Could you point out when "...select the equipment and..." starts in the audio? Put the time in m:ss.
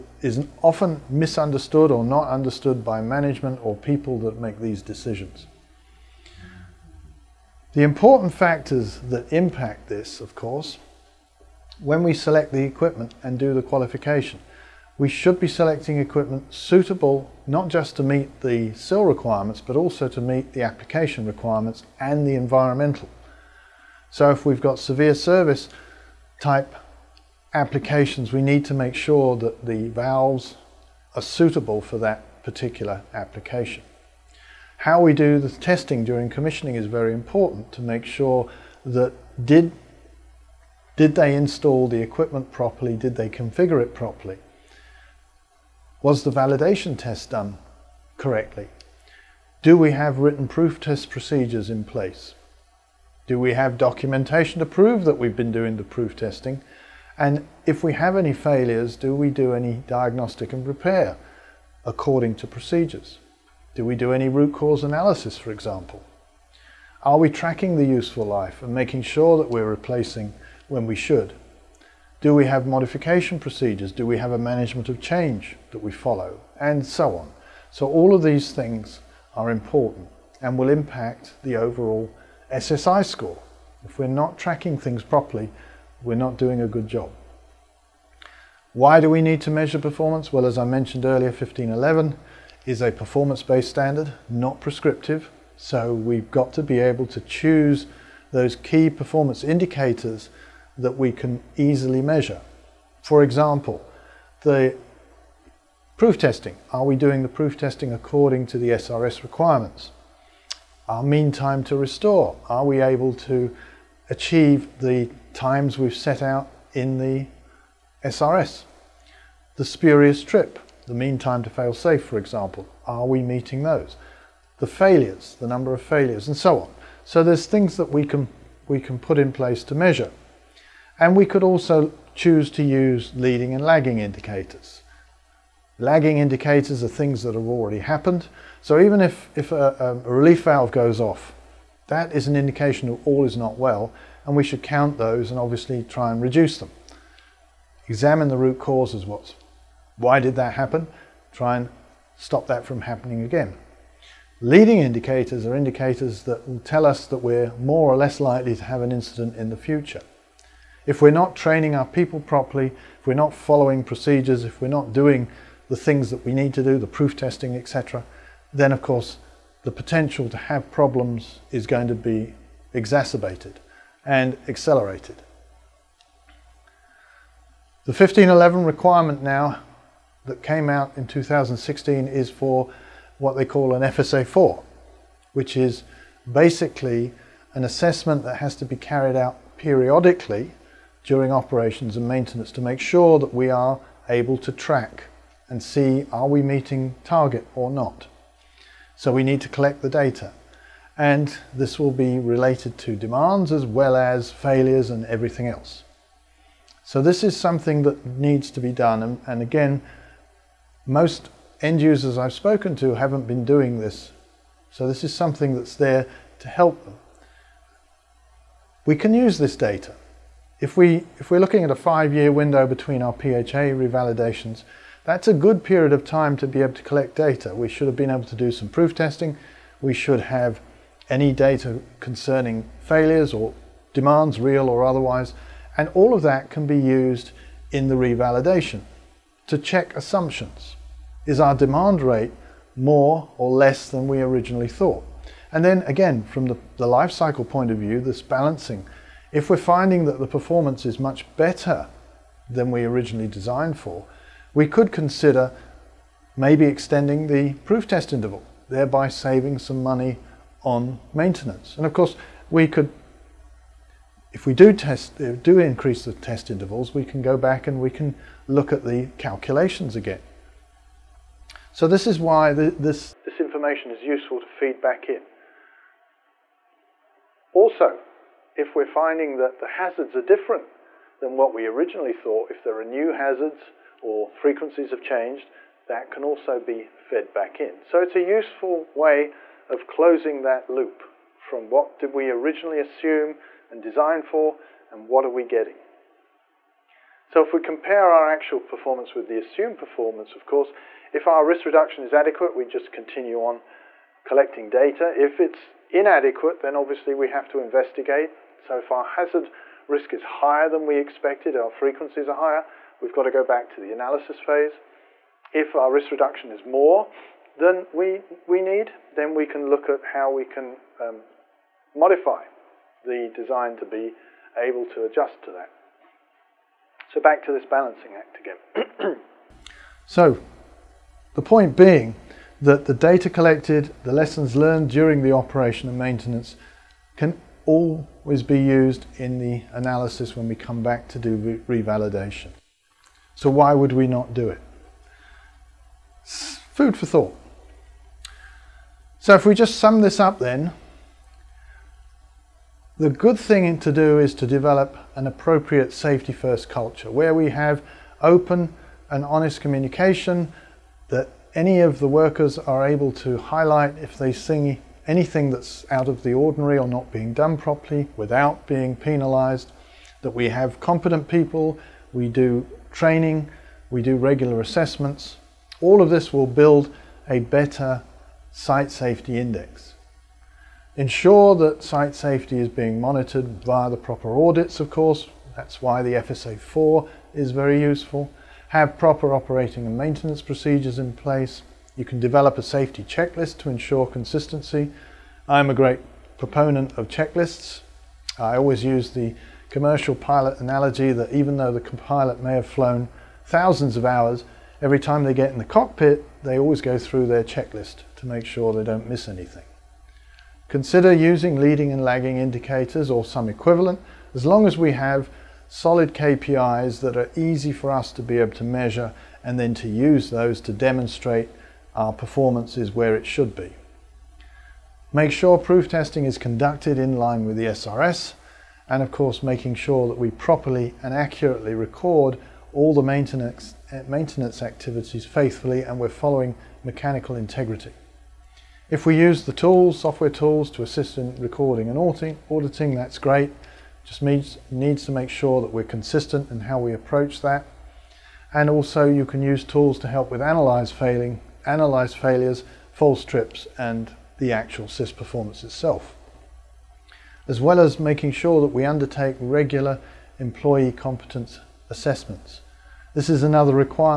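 0:12.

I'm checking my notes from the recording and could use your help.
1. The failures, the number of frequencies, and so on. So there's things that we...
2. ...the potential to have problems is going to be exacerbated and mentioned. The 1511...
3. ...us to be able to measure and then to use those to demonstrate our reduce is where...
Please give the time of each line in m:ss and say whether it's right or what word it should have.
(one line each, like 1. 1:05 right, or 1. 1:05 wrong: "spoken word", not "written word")
1. 2:04 wrong: "failures", not "frequencies"
2. 2:49 wrong: "accelerated", not "mentioned"
3. 6:57 wrong: "performance", not "reduce".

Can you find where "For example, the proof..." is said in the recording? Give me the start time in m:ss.
1:43.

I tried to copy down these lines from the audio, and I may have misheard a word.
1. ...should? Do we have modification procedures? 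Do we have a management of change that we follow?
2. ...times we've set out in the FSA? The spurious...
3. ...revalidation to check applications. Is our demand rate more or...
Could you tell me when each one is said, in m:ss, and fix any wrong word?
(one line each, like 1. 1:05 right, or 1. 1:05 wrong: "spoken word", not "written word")
1. 1:10 right
2. 1:55 wrong: "SRS", not "FSA"
3. 3:57 wrong: "assumptions", not "applications".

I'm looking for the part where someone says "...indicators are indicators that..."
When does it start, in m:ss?
2:34.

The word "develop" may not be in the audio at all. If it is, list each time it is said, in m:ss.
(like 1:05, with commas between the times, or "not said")
5:54, 6:32.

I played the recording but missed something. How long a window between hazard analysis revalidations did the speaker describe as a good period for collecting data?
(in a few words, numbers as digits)
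5 years.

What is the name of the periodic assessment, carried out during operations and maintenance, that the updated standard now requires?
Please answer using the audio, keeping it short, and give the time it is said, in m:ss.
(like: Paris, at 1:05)
FSA4, at 3:03.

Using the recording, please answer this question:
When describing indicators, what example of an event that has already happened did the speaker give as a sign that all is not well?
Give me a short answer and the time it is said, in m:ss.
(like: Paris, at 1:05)
relief valve goes off, at 2:20.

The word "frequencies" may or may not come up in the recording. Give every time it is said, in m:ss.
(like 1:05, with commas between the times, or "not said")
4:44, 5:11.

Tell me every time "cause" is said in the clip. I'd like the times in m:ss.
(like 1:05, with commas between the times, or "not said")
1:04, 2:28.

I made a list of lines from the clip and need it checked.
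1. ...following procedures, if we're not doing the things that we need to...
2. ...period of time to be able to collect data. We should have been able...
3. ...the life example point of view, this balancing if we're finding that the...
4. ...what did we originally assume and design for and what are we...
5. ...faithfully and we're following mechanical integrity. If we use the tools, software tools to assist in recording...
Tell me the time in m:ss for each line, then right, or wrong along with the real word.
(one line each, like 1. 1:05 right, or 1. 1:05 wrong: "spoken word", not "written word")
1. 2:43 right
2. 3:45 right
3. 4:06 wrong: "cycle", not "example"
4. 4:51 right
5. 7:15 right.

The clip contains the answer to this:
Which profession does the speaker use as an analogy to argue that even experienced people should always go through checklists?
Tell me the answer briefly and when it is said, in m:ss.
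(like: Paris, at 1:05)
commercial pilot, at 6:39.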